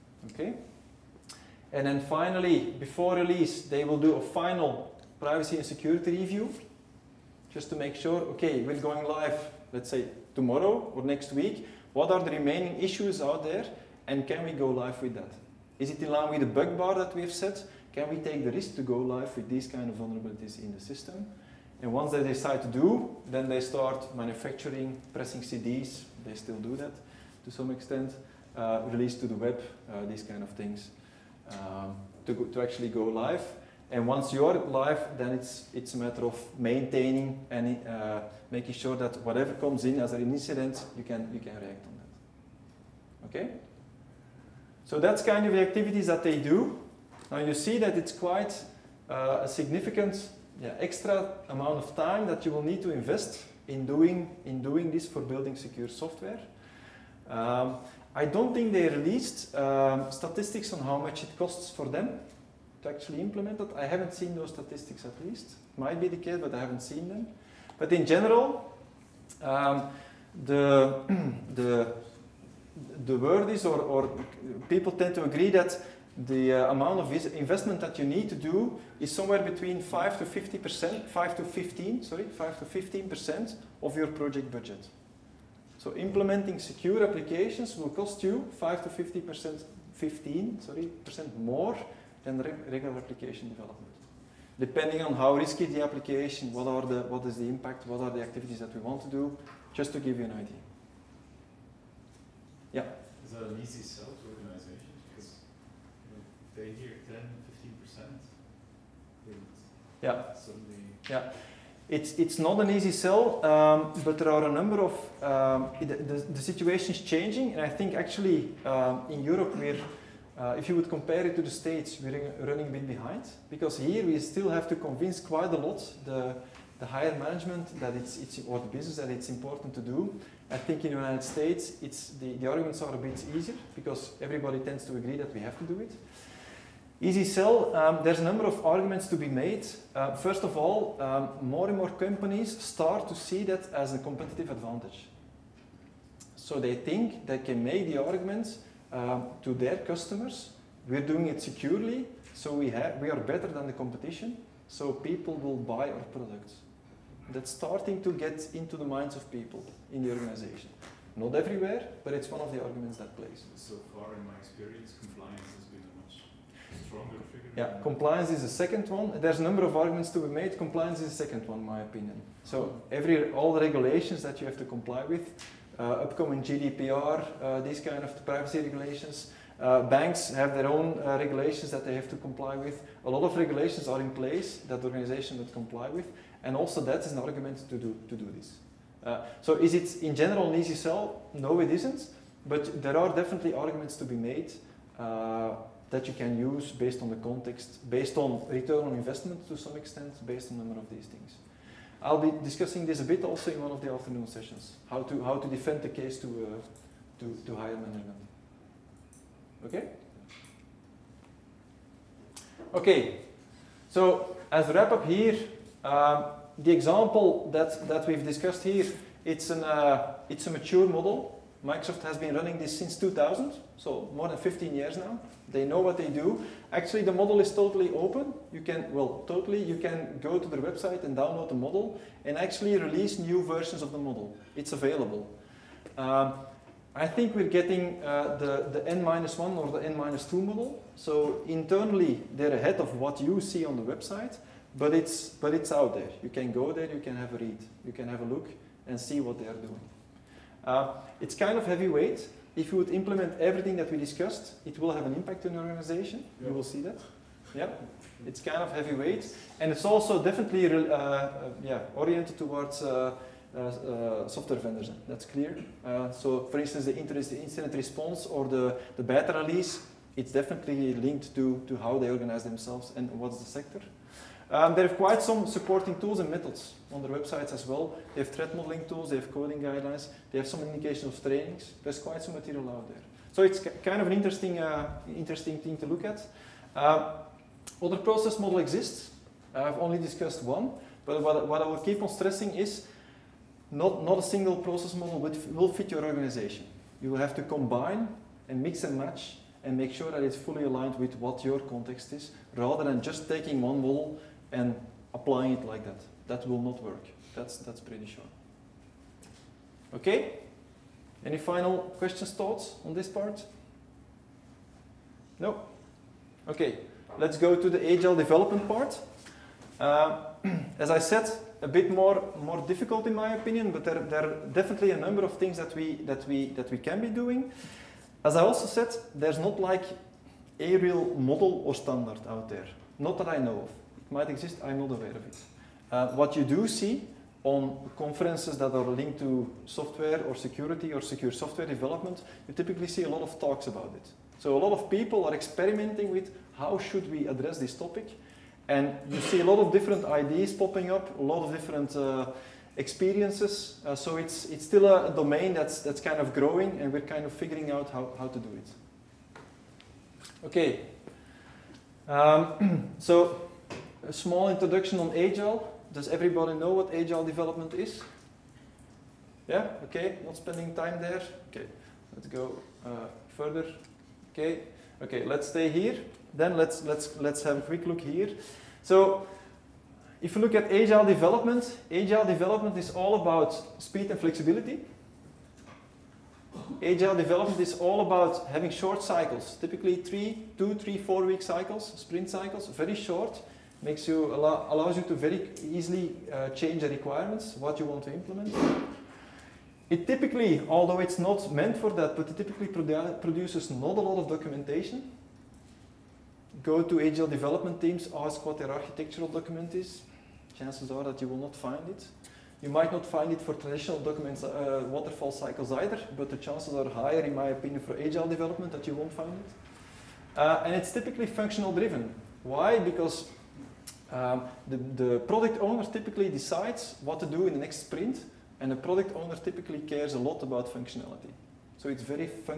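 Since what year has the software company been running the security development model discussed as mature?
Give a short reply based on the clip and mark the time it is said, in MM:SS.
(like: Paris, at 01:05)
2000, at 03:42.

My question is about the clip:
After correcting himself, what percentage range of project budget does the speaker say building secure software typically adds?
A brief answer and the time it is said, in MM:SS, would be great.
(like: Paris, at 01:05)
5 to 15 percent, at 01:22.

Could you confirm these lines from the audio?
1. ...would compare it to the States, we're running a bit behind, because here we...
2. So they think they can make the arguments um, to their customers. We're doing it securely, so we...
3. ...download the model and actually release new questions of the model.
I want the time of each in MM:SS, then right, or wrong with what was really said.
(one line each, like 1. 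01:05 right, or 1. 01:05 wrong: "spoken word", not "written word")
1. 02:00 right
2. 02:26 right
3. 03:51 wrong: "versions", not "questions".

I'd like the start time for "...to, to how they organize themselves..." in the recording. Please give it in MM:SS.
04:31.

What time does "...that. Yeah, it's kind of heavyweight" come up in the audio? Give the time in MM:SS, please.
04:16.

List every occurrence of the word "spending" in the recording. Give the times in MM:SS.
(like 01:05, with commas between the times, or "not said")
06:10.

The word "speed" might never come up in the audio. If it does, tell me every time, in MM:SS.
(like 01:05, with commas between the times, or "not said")
06:23.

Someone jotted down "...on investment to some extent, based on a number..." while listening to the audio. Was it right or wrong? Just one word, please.
right.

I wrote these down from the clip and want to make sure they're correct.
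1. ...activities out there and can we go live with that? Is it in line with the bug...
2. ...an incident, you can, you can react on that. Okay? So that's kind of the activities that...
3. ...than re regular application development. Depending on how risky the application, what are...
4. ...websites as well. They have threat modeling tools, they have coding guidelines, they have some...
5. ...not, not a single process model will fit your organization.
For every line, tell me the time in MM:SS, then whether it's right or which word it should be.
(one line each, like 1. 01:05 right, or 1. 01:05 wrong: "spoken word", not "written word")
1. 00:12 wrong: "issues", not "activities"
2. 00:40 right
3. 01:32 right
4. 04:37 right
5. 04:53 right.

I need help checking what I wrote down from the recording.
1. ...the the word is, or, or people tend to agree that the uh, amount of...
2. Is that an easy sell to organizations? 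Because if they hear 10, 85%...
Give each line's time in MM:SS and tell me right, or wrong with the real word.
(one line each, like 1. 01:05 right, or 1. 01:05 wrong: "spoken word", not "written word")
1. 01:11 right
2. 01:43 wrong: "15", not "85".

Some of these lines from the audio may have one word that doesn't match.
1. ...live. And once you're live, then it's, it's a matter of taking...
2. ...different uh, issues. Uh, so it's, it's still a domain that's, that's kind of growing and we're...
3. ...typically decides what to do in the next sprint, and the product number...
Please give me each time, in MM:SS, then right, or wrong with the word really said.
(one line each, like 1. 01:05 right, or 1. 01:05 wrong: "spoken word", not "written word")
1. 00:33 wrong: "maintaining", not "taking"
2. 05:51 wrong: "experiences", not "issues"
3. 07:05 wrong: "owner", not "number".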